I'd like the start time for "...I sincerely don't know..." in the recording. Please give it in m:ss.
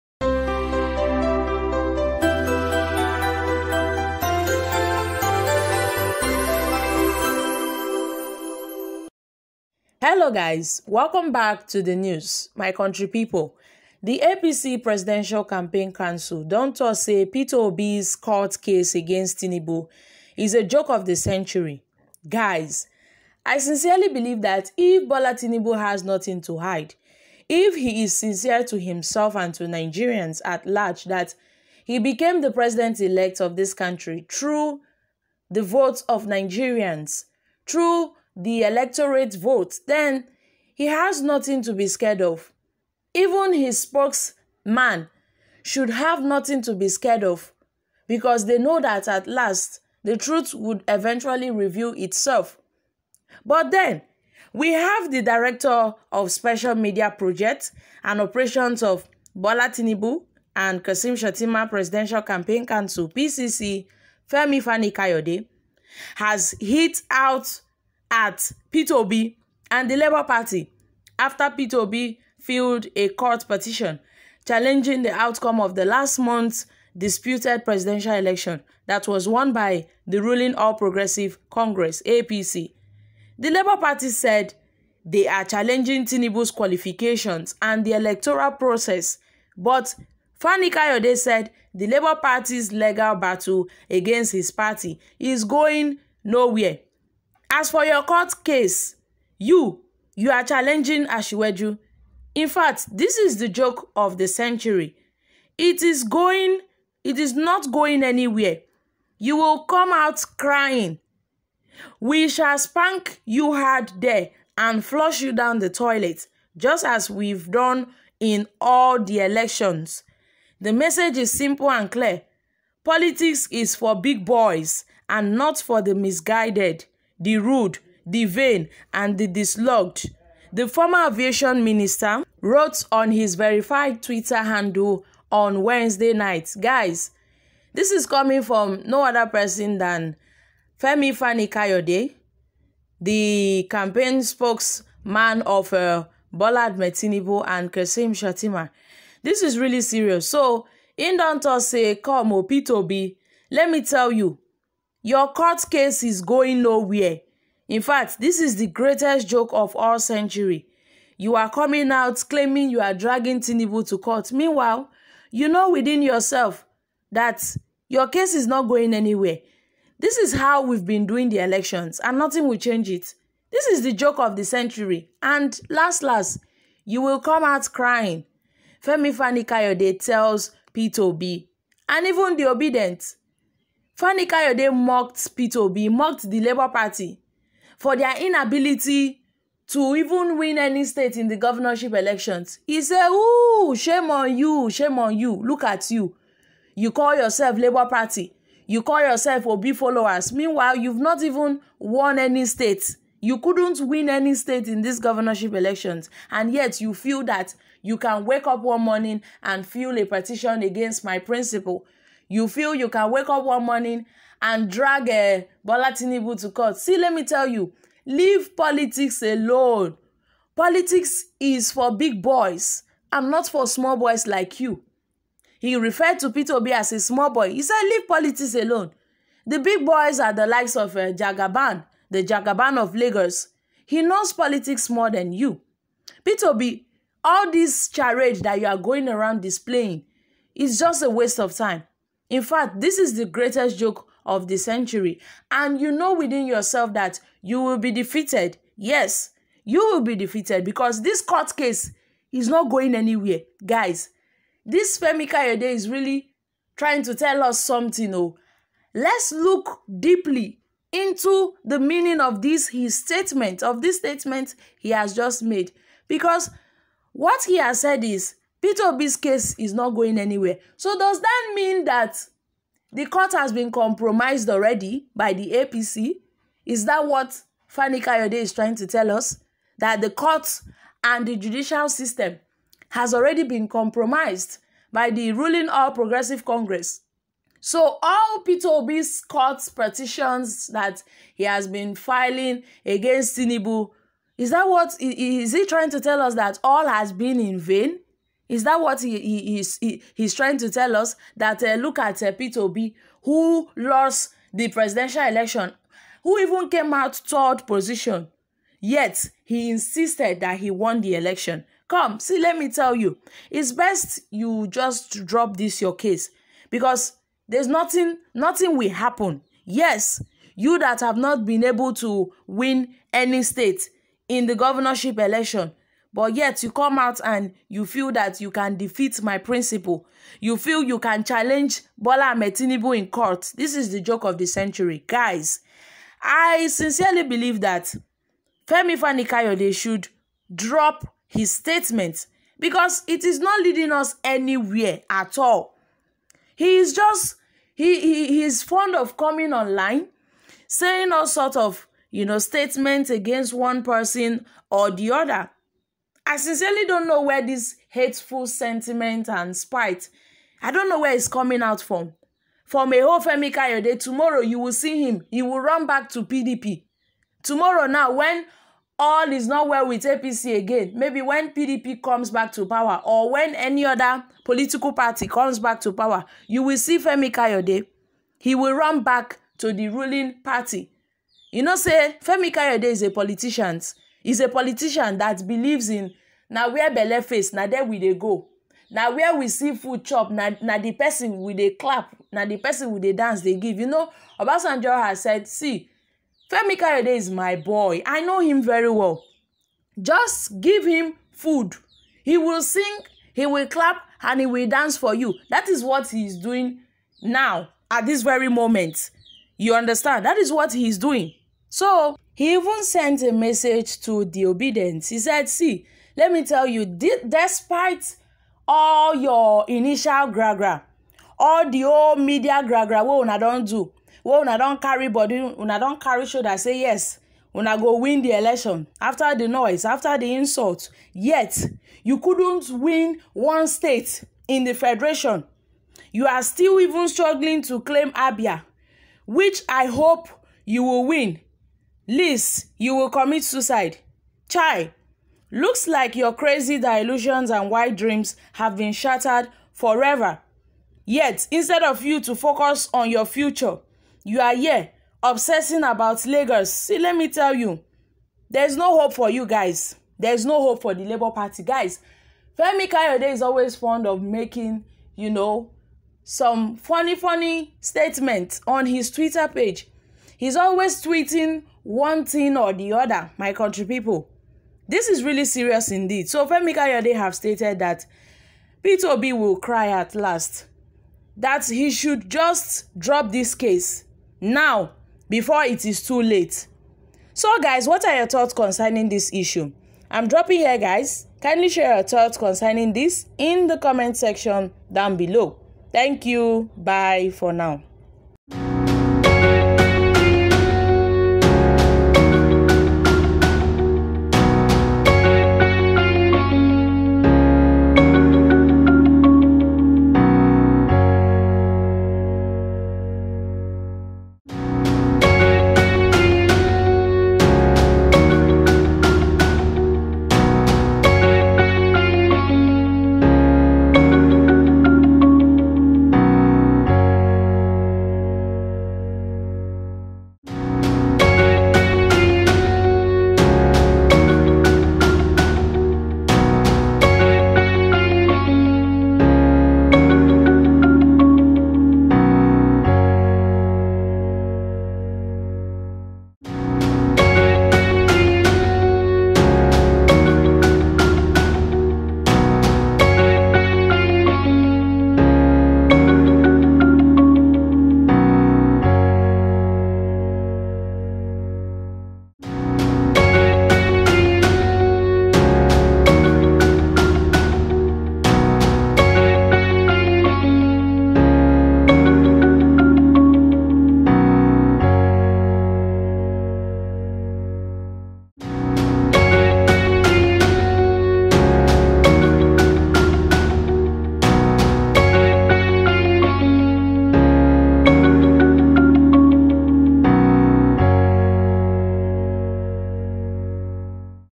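5:56.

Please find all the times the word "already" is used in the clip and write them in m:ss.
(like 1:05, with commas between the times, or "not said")
4:34, 4:43.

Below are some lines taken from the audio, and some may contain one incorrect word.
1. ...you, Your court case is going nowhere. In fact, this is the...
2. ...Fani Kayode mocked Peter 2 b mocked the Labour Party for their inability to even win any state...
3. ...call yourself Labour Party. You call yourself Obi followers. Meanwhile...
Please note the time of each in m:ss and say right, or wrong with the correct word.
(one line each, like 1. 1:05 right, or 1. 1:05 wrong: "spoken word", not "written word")
1. 2:34 right
2. 3:04 right
3. 3:16 right.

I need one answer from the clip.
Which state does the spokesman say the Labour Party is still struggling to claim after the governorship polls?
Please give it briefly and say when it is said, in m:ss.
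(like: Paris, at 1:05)
Abia, at 7:18.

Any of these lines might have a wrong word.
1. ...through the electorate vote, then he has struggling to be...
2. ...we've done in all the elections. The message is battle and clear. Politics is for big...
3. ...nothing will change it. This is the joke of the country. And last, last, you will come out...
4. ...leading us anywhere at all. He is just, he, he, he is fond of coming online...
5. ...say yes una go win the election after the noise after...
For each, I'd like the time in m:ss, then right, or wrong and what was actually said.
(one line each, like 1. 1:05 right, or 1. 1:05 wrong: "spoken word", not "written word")
1. 0:37 wrong: "nothing", not "struggling"
2. 1:57 wrong: "simple", not "battle"
3. 2:52 wrong: "century", not "country"
4. 5:43 right
5. 7:06 right.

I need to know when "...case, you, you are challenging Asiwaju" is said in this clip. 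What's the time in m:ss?
1:38.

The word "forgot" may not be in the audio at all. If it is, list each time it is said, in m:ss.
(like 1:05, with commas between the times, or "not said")
not said.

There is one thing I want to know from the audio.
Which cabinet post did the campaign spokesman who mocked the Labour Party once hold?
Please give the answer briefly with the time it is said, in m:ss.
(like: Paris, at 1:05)
Aviation minister, at 2:11.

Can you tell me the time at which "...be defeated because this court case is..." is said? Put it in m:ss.
4:09.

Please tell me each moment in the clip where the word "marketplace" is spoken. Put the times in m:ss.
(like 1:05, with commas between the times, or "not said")
not said.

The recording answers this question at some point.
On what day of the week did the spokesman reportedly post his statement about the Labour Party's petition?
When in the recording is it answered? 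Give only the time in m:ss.
2:15.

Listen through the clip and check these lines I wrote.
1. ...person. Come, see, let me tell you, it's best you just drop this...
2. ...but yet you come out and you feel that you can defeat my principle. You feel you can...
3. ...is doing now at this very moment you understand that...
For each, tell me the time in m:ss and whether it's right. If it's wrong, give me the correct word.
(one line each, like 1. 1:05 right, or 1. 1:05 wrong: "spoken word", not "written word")
1. 5:11 wrong: "election", not "person"
2. 5:26 right
3. 6:46 right.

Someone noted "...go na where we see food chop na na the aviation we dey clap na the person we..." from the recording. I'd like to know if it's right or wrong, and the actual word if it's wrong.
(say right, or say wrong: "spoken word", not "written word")
wrong: "person", not "aviation".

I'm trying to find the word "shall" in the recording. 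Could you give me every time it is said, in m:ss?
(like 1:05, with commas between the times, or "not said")
1:52.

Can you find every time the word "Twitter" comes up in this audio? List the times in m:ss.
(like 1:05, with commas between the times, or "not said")
2:14, 7:49.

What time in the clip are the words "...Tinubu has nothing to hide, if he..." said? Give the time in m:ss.
0:25.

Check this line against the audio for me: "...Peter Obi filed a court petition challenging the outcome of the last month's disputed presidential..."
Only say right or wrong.
right.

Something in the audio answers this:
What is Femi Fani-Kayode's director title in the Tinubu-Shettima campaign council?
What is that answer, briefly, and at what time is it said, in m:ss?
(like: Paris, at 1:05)
Special media projects and operations, at 0:56.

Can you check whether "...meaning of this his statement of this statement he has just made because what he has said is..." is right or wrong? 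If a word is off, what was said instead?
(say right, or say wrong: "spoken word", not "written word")
right.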